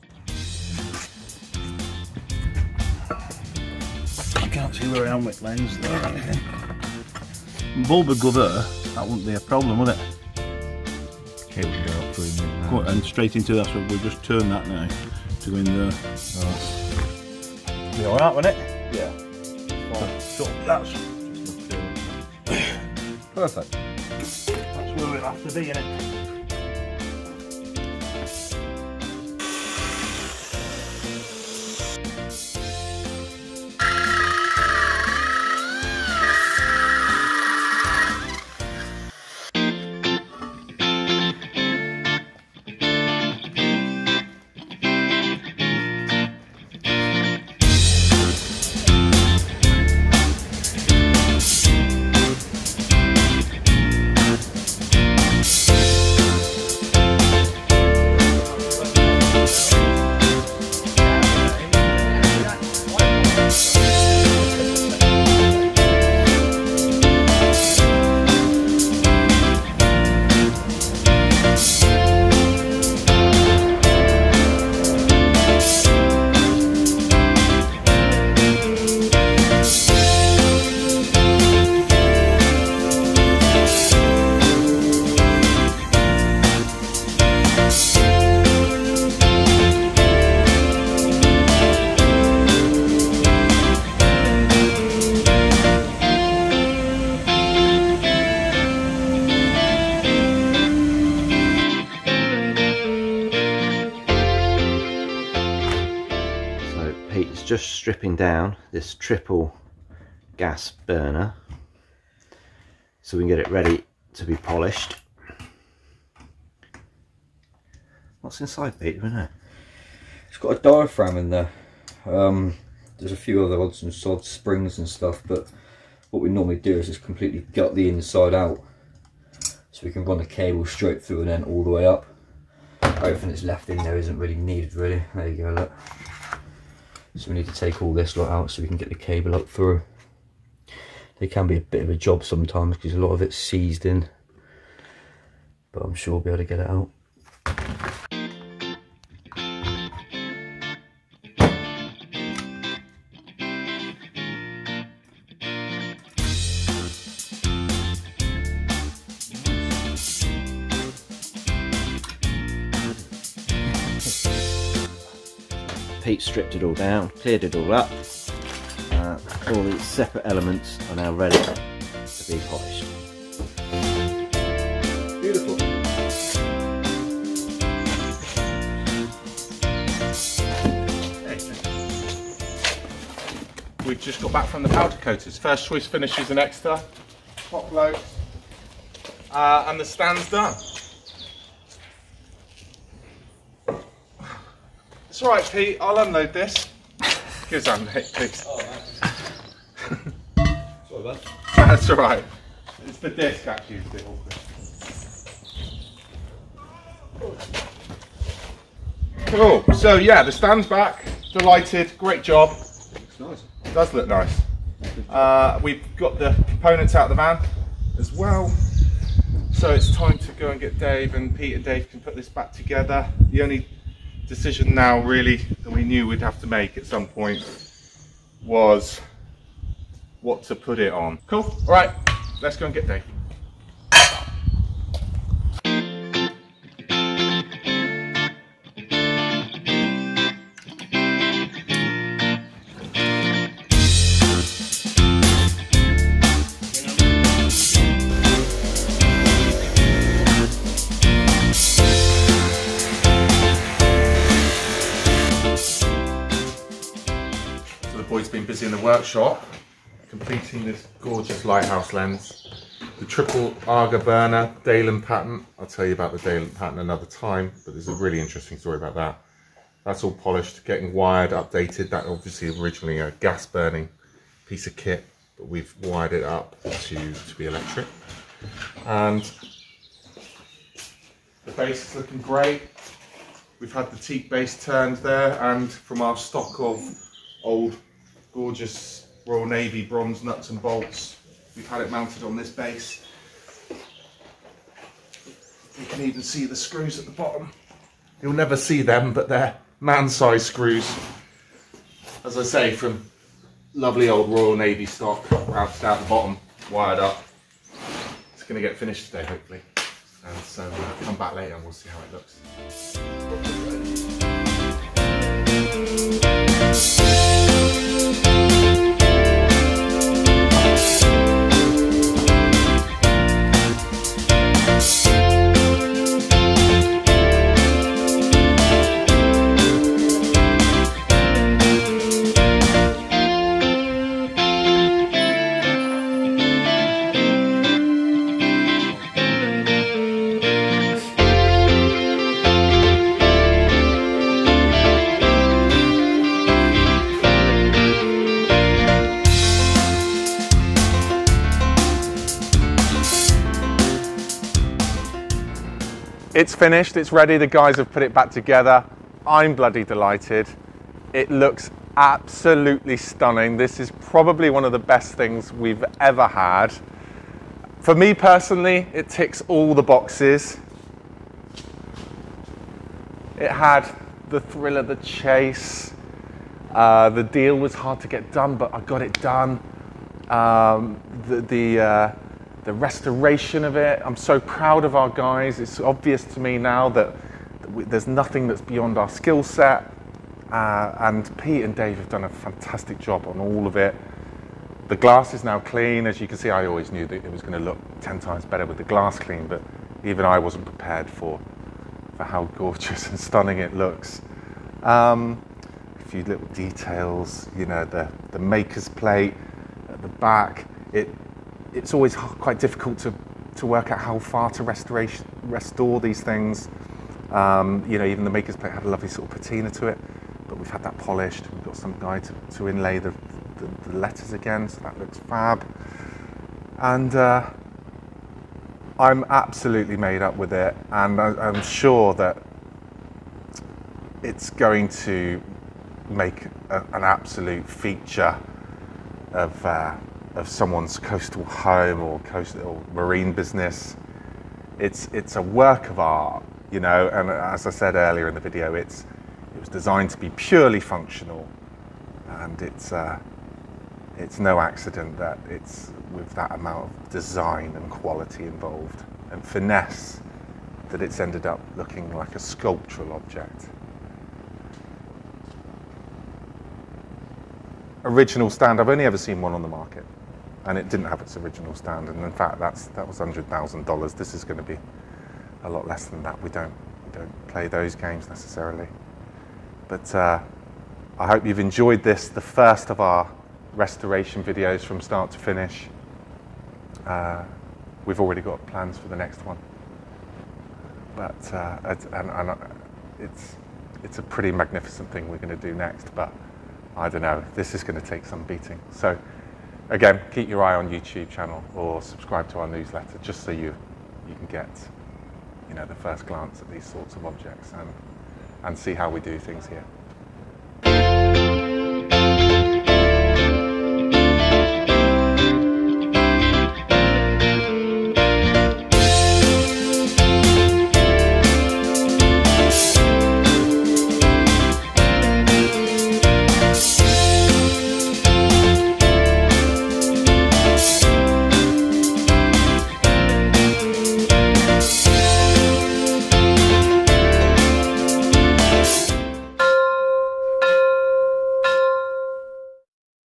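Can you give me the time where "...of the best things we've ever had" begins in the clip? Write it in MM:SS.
06:04.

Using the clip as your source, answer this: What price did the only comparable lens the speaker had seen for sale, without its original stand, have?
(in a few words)
$100,000.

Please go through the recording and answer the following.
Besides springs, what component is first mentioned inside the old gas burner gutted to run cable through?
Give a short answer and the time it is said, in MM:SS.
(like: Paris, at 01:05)
Diaphragm, at 02:00.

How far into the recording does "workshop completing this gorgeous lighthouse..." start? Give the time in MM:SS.
04:18.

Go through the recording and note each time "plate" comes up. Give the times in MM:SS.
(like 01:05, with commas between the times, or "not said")
06:48, 06:58.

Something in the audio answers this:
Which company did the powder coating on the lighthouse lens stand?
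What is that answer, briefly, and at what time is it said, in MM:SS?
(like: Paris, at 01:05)
First Choice Finishes, at 03:05.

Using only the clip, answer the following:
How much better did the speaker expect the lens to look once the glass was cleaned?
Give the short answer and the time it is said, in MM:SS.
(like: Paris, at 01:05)
10 times better, at 06:38.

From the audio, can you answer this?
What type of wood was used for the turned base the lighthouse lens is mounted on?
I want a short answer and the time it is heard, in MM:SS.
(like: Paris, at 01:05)
Teak, at 04:43.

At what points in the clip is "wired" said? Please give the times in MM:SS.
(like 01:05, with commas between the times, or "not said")
04:30, 04:35, 05:06.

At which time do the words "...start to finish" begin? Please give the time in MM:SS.
08:05.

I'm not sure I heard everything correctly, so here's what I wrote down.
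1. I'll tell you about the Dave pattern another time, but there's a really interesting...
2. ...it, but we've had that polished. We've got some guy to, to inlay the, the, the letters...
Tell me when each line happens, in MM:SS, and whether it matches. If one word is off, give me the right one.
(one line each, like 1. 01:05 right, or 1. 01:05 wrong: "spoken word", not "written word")
1. 04:25 wrong: "Dalen", not "Dave"
2. 06:59 right.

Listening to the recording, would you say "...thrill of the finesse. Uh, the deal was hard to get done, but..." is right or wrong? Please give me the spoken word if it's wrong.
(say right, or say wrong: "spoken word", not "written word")
wrong: "chase", not "finesse".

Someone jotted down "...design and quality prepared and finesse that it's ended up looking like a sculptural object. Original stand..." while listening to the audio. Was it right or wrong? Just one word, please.
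wrong.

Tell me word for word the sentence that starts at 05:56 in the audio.
It's finished, it's ready, the guys have put it back together.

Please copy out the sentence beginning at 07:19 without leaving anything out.
Uh, of someone's coastal home or coastal marine business.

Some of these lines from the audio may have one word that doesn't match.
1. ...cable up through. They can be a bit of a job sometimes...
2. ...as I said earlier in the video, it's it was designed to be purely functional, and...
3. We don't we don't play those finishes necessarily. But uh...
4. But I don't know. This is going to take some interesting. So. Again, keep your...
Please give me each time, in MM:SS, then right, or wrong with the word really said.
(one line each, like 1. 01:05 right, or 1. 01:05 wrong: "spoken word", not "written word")
1. 02:18 right
2. 07:27 right
3. 07:56 wrong: "games", not "finishes"
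4. 08:16 wrong: "beating", not "interesting".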